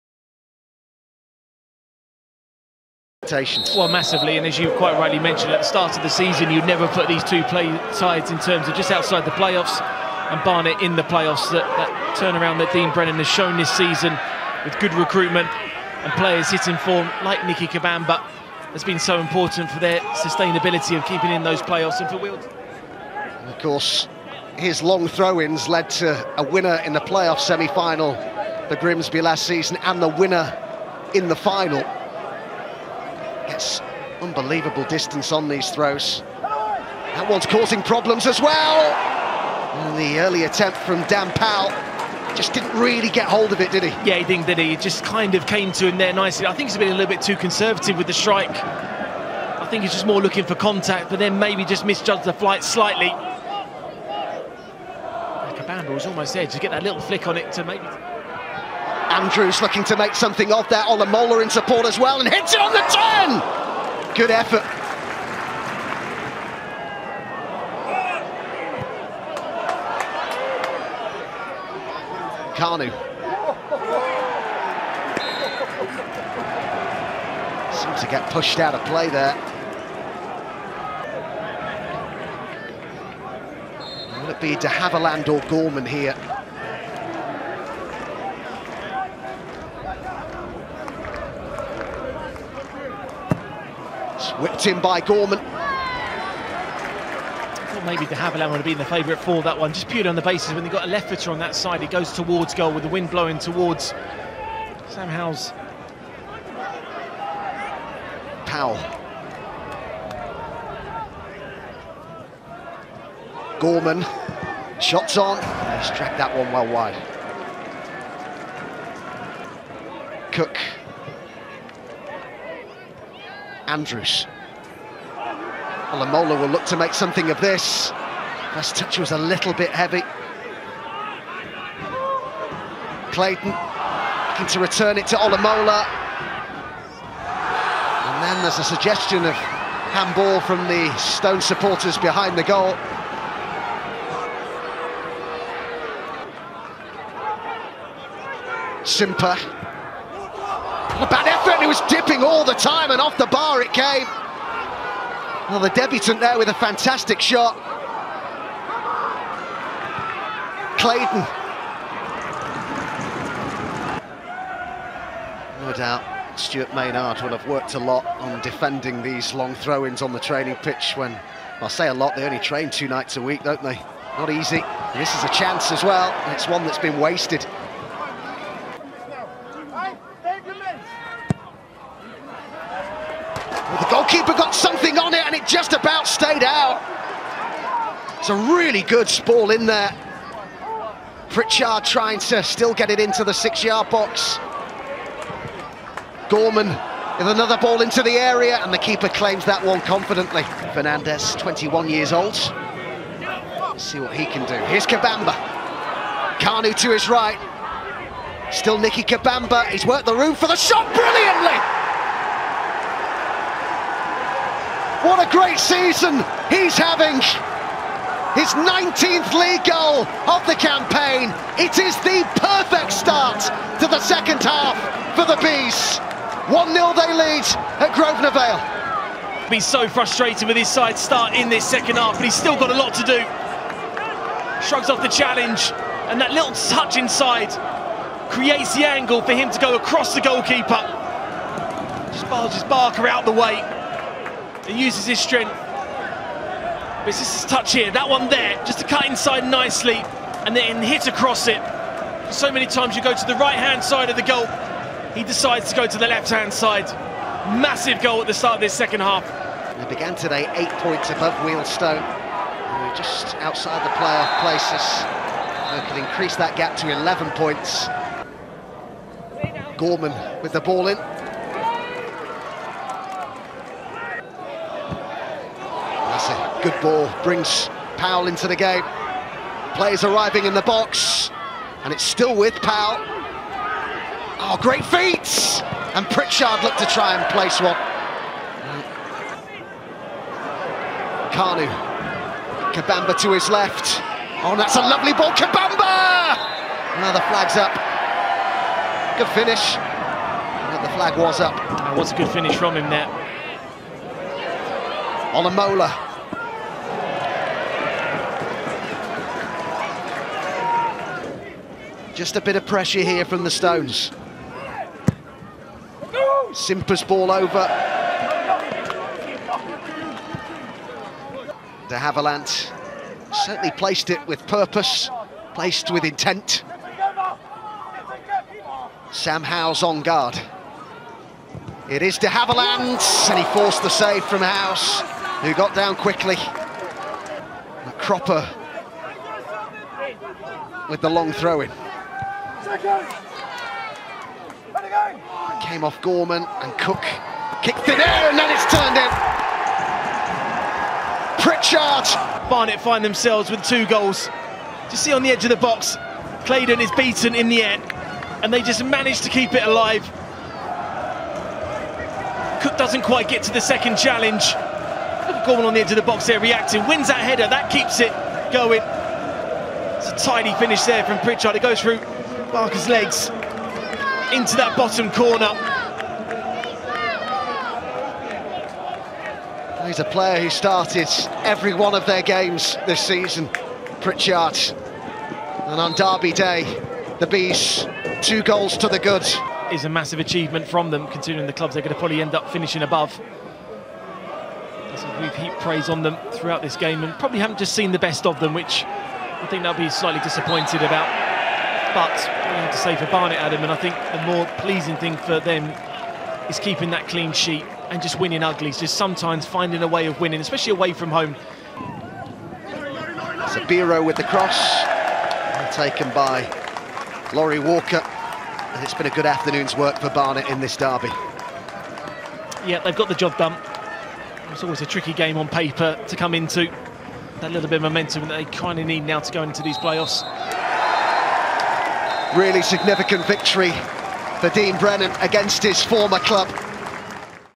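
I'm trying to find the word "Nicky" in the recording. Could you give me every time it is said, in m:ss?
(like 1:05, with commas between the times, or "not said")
0:17, 3:28.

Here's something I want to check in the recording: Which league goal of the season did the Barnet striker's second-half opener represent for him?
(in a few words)
19th.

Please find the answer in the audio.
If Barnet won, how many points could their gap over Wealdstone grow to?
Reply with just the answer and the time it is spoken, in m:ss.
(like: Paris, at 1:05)
11, at 4:26.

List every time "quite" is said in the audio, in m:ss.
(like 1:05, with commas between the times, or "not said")
0:04, 6:03.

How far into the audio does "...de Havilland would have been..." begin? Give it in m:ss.
1:38.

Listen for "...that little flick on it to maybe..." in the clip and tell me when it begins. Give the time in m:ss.
0:56.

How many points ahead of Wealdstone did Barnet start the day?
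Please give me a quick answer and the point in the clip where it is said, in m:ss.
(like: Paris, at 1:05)
8, at 4:20.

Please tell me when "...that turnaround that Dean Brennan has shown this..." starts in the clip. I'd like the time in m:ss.
0:11.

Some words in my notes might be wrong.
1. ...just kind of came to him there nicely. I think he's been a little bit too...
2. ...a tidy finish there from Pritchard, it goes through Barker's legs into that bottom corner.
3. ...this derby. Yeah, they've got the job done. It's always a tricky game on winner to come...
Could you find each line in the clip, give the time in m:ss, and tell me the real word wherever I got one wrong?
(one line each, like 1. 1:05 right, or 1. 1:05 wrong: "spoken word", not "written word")
1. 0:44 right
2. 6:10 right
3. 7:00 wrong: "paper", not "winner".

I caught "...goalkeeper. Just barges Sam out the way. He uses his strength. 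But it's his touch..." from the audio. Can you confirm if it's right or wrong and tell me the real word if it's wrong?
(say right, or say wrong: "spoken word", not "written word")
wrong: "Barker", not "Sam".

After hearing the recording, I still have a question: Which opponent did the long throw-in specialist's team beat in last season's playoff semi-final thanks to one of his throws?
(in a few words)
Grimsby.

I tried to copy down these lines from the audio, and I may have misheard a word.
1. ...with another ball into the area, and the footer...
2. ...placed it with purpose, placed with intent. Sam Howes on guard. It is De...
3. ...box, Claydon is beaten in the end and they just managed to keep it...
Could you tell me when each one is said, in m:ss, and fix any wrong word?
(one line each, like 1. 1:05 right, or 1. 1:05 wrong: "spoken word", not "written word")
1. 3:16 wrong: "keeper", not "footer"
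2. 5:23 right
3. 5:55 right.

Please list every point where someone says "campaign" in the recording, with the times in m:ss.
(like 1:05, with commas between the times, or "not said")
3:40.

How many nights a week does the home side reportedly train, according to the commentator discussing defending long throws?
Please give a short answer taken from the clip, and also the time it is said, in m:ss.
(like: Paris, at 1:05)
2, at 2:52.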